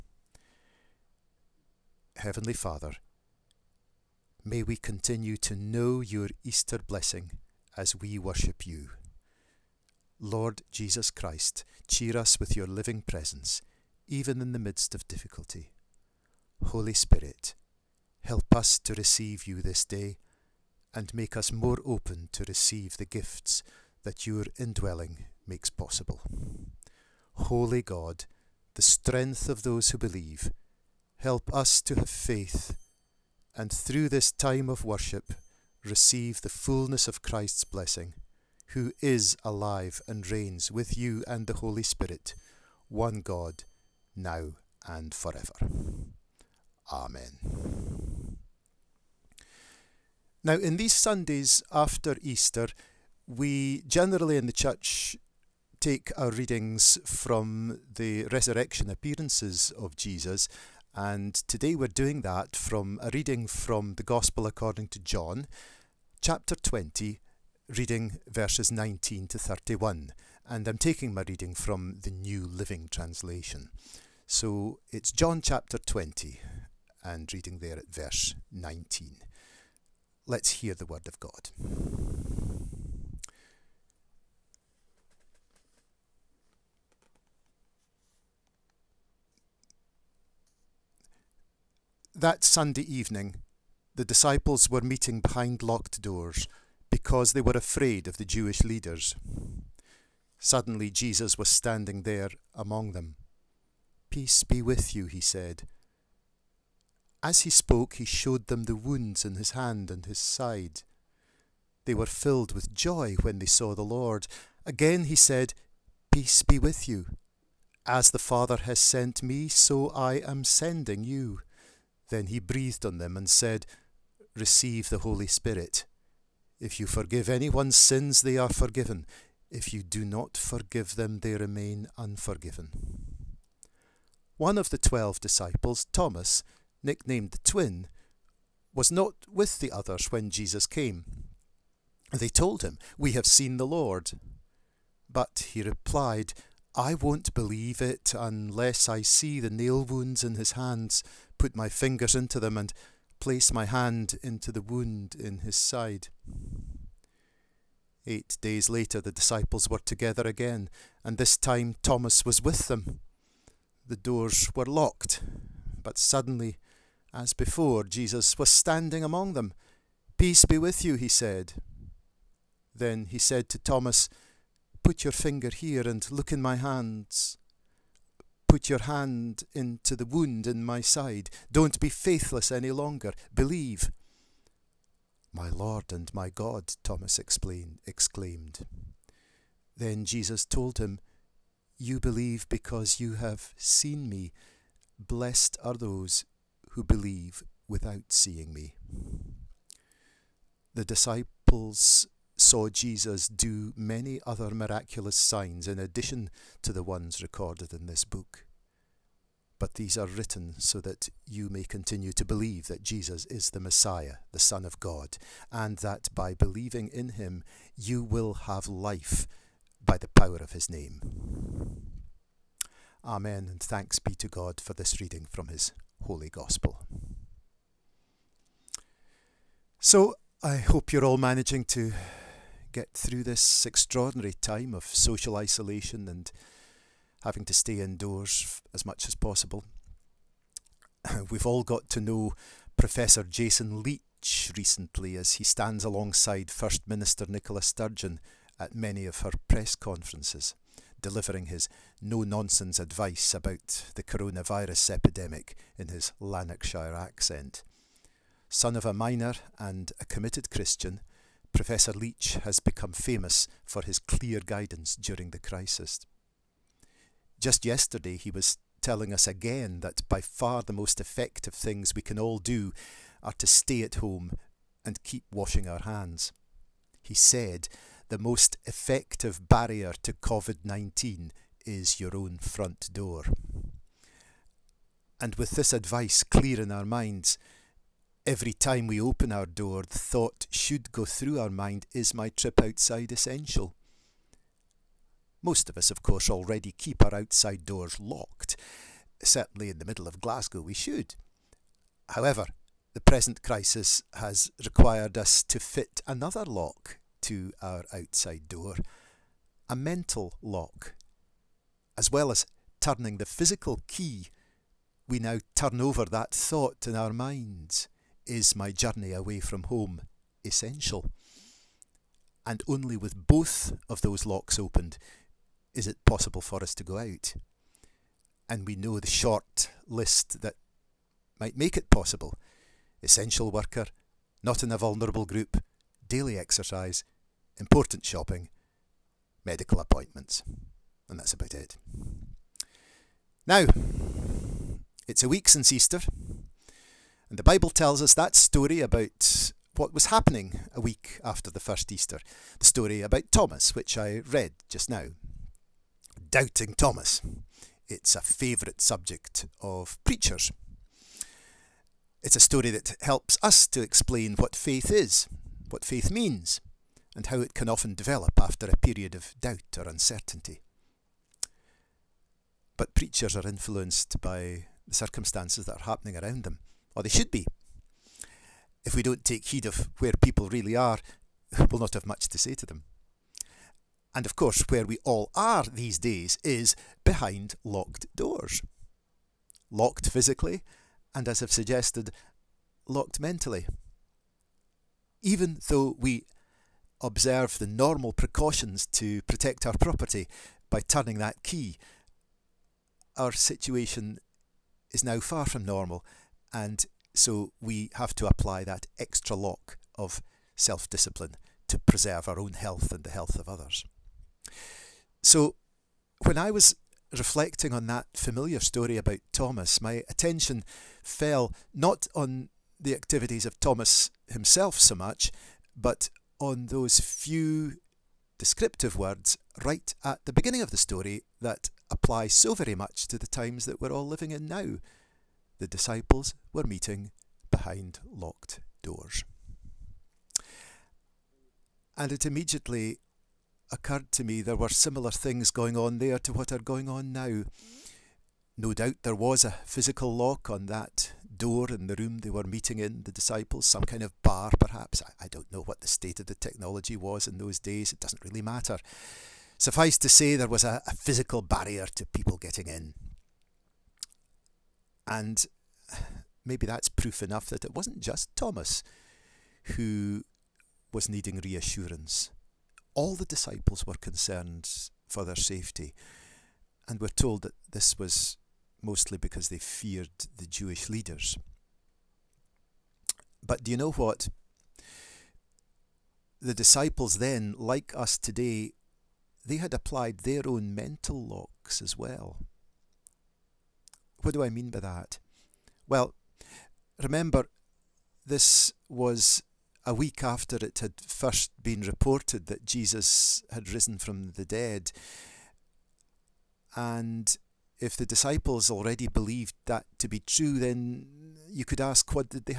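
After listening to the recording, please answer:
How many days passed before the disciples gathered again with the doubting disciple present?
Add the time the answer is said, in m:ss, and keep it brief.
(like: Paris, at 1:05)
8, at 2:38.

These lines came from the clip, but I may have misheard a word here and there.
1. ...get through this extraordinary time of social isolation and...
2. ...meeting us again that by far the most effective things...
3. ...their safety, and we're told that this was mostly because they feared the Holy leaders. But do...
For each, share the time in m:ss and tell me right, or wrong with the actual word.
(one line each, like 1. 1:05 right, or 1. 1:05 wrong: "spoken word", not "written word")
1. 3:52 right
2. 4:28 wrong: "telling", not "meeting"
3. 7:55 wrong: "Jewish", not "Holy".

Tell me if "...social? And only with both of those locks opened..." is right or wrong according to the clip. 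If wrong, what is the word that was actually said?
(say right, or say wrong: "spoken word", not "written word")
wrong: "essential", not "social".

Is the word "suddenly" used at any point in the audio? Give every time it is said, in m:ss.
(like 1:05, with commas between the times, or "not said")
1:40, 2:45.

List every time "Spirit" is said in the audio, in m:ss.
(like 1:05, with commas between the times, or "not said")
0:16, 0:41, 2:05.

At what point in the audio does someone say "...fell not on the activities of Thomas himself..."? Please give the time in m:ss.
7:01.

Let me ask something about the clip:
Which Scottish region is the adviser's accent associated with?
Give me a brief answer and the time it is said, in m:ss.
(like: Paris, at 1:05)
Lanarkshire, at 4:16.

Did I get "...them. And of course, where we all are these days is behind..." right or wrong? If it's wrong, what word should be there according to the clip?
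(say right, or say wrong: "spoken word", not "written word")
right.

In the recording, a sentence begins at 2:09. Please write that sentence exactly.
If you do not forgive them, they remain unforgiven.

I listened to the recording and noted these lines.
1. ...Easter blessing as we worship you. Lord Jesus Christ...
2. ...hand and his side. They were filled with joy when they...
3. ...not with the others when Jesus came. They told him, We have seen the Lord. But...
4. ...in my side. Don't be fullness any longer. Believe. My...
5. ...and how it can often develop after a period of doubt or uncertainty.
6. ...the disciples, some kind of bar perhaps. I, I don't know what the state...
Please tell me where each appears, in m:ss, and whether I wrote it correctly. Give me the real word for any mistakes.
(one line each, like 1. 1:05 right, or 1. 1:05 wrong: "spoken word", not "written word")
1. 0:06 right
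2. 1:49 right
3. 2:18 right
4. 3:00 wrong: "faithless", not "fullness"
5. 6:07 right
6. 7:33 right.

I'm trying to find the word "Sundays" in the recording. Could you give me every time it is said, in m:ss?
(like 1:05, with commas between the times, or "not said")
0:50, 1:32.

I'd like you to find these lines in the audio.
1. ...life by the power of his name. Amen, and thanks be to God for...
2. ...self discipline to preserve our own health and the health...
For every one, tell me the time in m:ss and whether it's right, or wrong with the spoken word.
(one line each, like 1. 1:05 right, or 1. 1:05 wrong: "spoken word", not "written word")
1. 3:38 right
2. 6:50 right.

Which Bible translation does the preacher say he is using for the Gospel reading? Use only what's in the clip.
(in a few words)
New Living Translation.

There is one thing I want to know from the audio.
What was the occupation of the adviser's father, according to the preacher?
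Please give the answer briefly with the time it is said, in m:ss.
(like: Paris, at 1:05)
miner, at 4:18.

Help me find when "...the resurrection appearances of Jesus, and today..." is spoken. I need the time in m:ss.
0:57.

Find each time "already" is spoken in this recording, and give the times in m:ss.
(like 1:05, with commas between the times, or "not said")
4:56, 8:28.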